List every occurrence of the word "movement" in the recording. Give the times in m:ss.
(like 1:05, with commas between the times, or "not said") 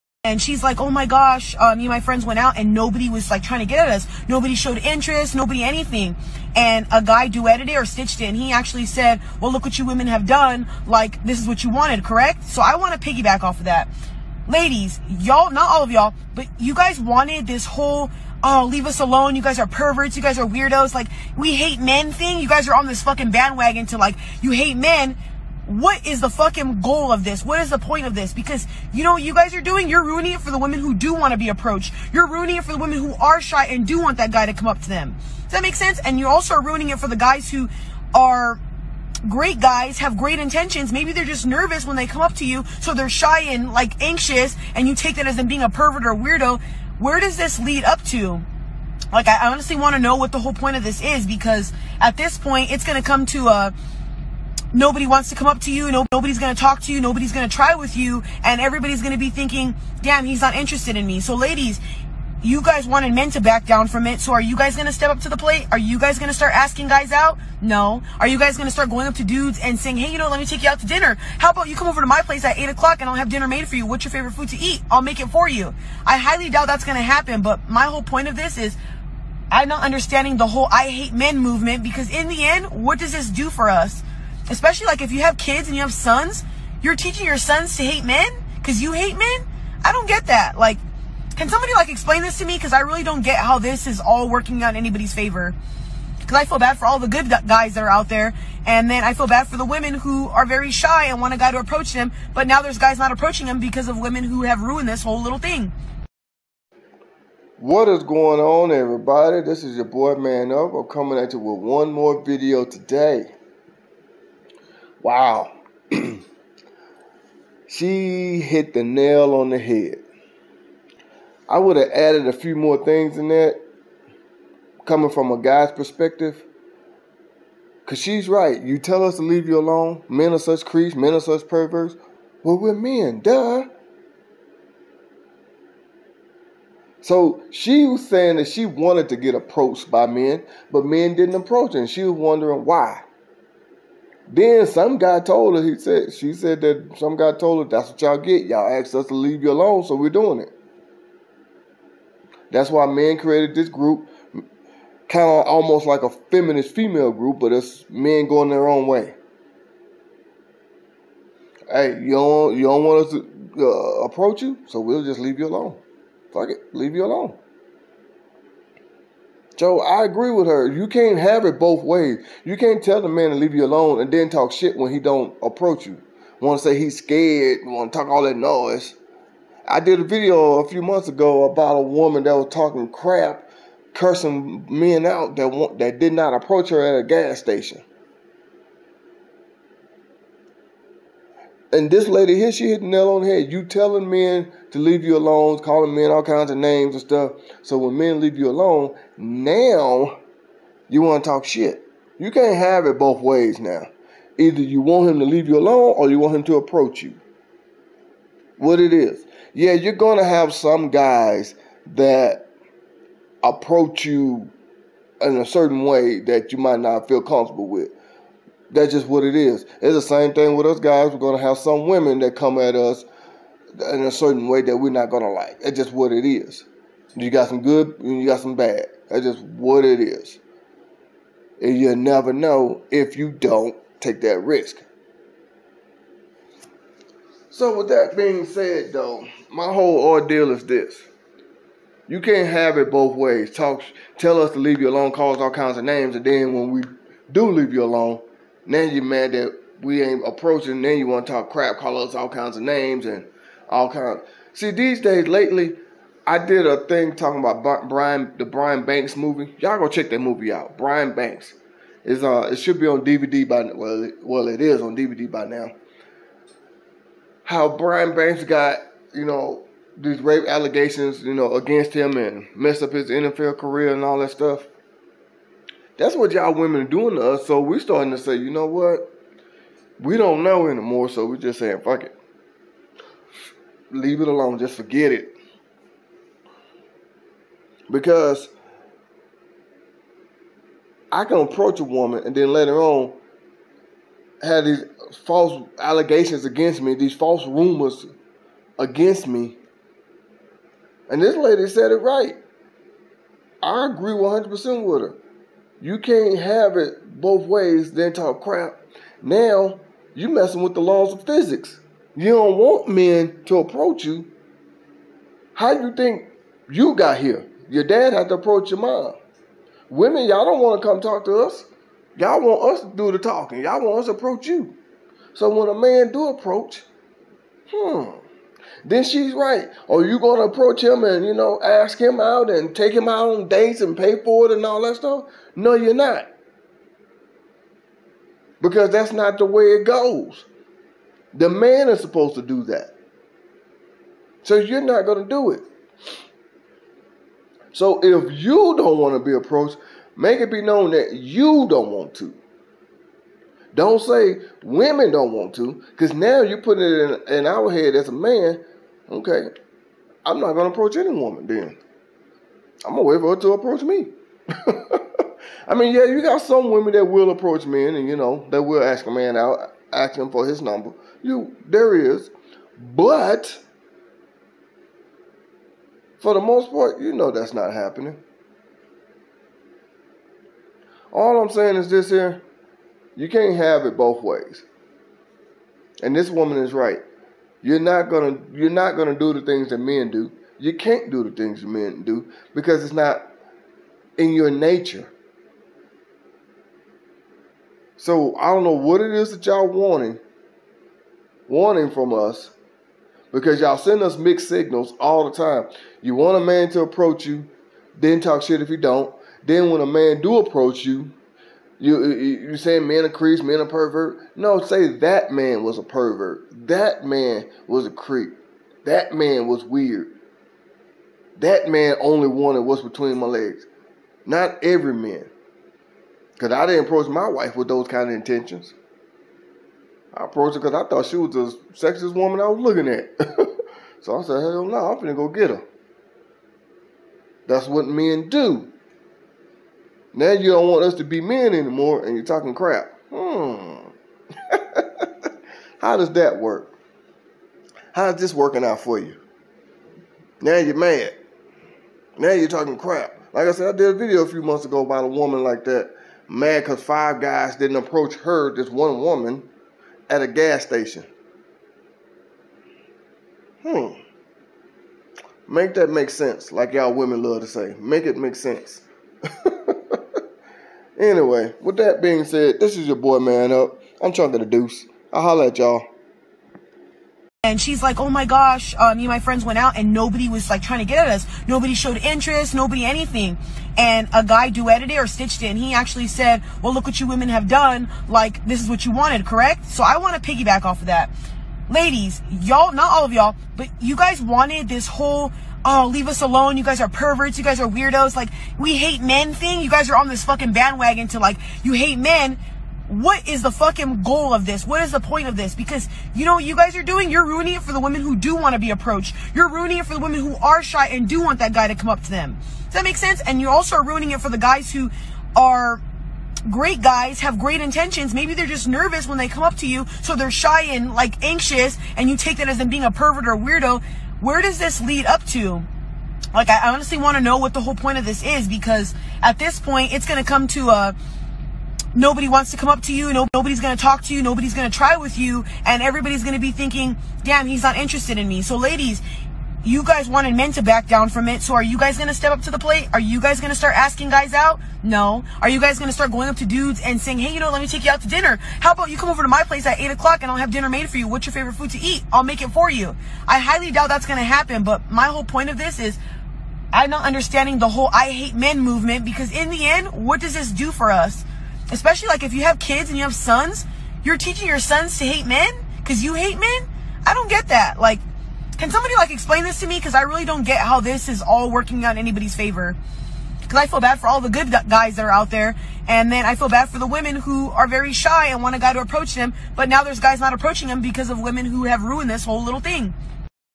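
1:21, 9:18.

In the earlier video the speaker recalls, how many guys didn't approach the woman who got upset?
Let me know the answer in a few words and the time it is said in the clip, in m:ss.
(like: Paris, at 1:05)
5, at 7:36.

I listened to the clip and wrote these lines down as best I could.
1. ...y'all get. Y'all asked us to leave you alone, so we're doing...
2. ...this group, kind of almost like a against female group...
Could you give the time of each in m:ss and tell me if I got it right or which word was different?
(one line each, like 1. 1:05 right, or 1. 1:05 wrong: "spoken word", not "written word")
1. 2:28 right
2. 2:33 wrong: "feminist", not "against".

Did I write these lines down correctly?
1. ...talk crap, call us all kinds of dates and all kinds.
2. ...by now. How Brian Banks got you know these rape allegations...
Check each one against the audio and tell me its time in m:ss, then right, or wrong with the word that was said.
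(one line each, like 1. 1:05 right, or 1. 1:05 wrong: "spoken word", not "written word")
1. 4:11 wrong: "names", not "dates"
2. 4:25 right.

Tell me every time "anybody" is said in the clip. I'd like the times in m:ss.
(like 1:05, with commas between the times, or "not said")
1:34, 9:31.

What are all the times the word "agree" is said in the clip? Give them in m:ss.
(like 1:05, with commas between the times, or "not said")
2:50, 5:03.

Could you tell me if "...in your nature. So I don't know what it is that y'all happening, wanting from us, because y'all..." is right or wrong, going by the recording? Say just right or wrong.
wrong.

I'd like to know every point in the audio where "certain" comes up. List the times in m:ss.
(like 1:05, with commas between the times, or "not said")
3:35, 3:44.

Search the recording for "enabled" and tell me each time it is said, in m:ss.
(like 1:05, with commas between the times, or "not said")
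not said.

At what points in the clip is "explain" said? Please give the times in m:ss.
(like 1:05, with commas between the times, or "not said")
1:31, 9:29.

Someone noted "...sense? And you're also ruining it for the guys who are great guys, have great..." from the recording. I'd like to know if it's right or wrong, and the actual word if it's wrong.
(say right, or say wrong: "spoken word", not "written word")
right.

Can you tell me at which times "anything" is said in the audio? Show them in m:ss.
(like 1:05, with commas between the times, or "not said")
0:05, 8:02.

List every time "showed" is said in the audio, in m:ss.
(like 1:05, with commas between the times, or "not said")
0:04, 8:01.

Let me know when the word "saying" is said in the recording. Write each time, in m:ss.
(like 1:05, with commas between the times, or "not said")
1:09, 2:18, 4:41, 6:21, 6:52, 9:06.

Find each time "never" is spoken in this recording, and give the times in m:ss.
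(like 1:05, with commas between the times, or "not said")
3:51.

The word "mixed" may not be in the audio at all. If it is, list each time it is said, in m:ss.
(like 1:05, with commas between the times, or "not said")
6:44.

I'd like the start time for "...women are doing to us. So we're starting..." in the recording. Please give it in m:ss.
4:36.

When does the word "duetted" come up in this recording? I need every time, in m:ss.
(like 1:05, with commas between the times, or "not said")
0:07, 8:04.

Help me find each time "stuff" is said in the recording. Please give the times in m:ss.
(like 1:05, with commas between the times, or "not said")
3:17, 4:34, 5:34.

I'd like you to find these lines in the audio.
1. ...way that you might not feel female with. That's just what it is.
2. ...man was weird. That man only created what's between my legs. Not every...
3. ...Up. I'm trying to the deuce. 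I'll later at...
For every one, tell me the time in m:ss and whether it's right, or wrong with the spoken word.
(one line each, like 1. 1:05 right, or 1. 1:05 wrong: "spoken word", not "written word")
1. 3:35 wrong: "comfortable", not "female"
2. 6:59 wrong: "wanted", not "created"
3. 7:53 wrong: "holler", not "later".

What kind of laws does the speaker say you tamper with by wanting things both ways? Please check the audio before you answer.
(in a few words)
laws of physics.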